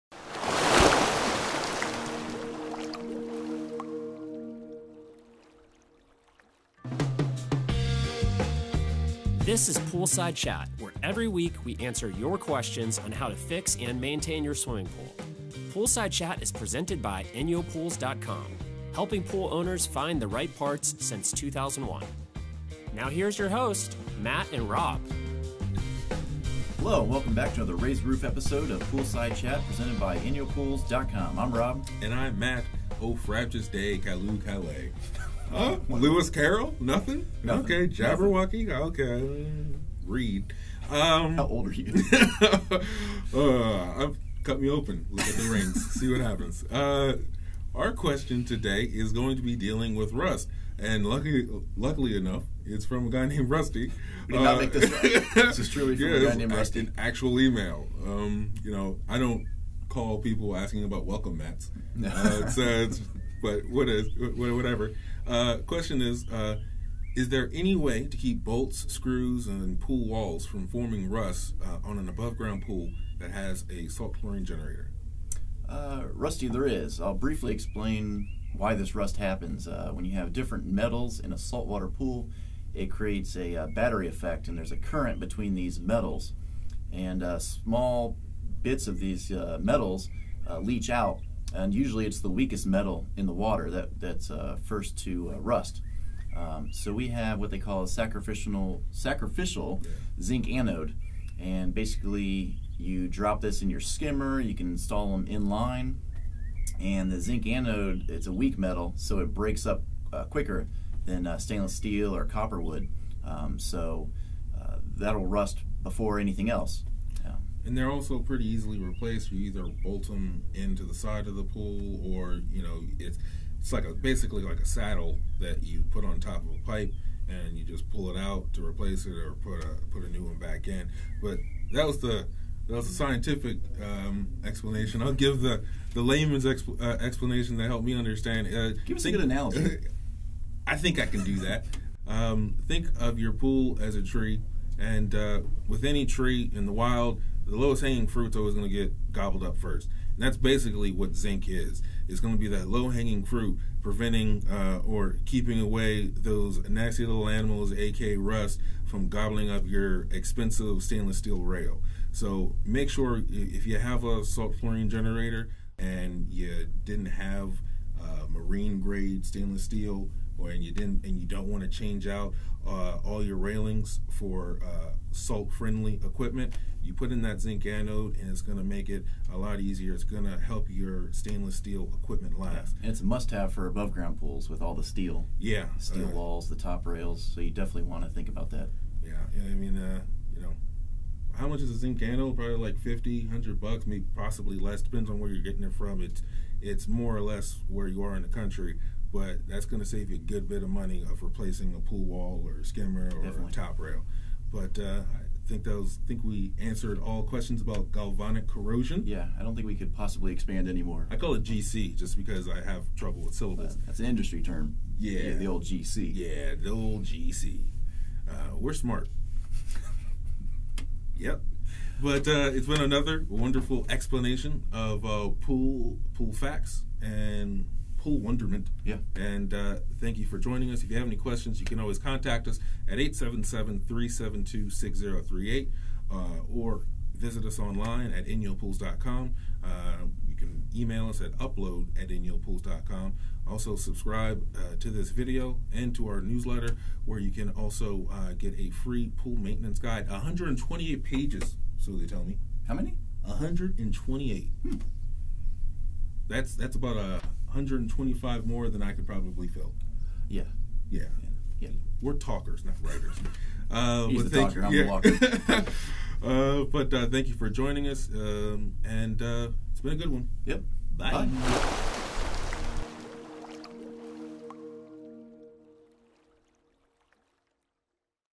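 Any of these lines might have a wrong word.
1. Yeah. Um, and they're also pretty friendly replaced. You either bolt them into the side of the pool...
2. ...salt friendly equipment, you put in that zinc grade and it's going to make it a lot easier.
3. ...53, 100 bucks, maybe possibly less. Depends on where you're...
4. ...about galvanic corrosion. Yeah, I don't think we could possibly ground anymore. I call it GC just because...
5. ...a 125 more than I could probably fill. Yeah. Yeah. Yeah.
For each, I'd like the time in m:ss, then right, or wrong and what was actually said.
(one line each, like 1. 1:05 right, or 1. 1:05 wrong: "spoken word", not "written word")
1. 1:57 wrong: "easily", not "friendly"
2. 2:55 wrong: "anode", not "grade"
3. 3:12 wrong: "50", not "53"
4. 3:27 wrong: "expand", not "ground"
5. 4:16 right.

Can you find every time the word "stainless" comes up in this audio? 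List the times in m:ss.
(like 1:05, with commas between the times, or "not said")
1:51, 2:40, 2:49, 3:01.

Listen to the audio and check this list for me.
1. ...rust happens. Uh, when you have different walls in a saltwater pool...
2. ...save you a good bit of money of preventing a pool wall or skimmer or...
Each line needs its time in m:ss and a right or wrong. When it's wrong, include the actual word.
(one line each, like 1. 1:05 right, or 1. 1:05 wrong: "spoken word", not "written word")
1. 1:18 wrong: "metals", not "walls"
2. 3:19 wrong: "replacing", not "preventing".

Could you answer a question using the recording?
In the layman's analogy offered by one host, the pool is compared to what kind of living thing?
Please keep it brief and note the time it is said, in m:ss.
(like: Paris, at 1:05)
A tree, at 2:23.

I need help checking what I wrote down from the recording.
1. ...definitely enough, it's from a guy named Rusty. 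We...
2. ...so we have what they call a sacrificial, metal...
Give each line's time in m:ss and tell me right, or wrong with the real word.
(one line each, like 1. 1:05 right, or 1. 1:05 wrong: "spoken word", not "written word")
1. 0:51 wrong: "luckily", not "definitely"
2. 1:36 wrong: "sacrificial", not "metal".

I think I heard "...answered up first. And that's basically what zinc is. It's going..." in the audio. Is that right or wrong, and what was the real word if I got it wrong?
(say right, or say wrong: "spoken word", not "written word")
wrong: "gobbled", not "answered".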